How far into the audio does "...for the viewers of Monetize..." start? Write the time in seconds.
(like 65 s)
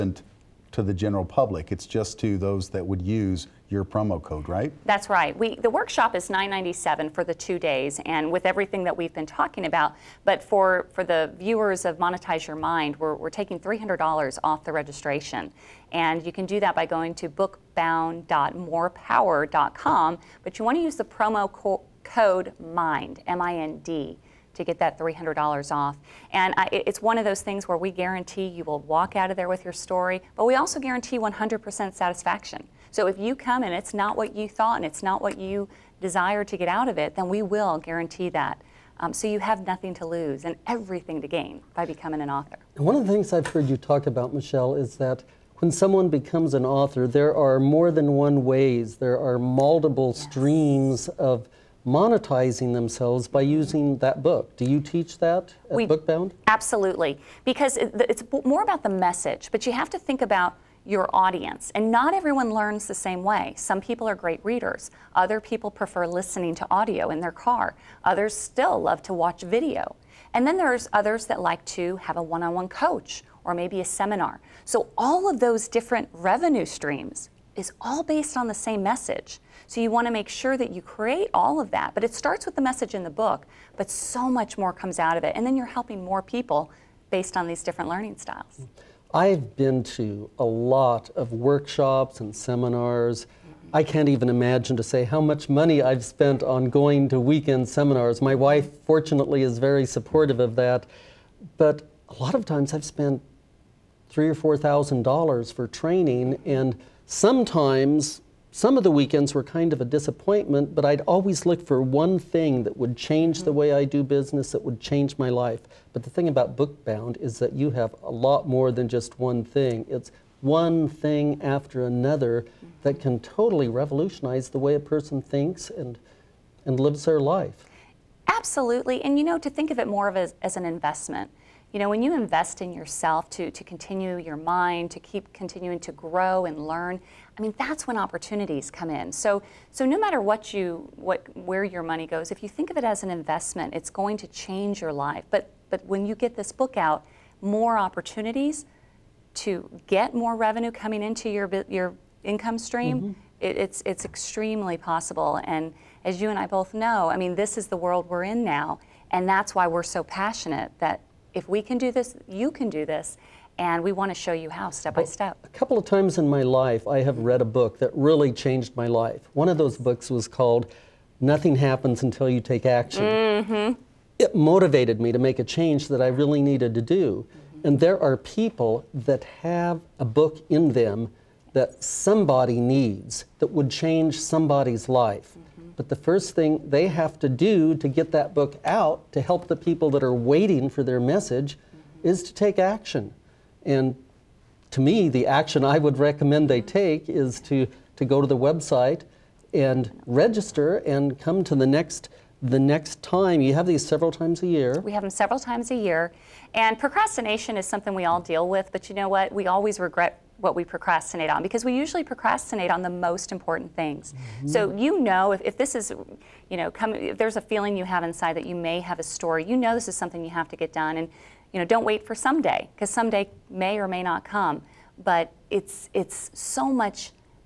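10 s.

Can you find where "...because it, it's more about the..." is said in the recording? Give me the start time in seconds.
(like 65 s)
57 s.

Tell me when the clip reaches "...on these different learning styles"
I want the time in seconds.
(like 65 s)
87 s.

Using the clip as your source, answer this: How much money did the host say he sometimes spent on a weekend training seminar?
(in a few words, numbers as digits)
3,000 or 4,000 dollars.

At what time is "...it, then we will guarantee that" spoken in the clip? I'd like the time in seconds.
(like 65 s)
36 s.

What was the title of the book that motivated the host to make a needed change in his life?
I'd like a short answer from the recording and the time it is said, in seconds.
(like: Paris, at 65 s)
Nothing Happens Until You Take Action, at 171 s.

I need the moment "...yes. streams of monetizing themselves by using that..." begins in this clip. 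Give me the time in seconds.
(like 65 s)
50 s.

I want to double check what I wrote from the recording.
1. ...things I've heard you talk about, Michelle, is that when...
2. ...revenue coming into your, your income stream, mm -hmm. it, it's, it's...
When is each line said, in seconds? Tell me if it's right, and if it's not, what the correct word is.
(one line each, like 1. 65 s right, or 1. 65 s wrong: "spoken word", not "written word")
1. 43 s right
2. 150 s right.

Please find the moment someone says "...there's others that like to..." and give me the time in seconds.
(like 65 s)
70 s.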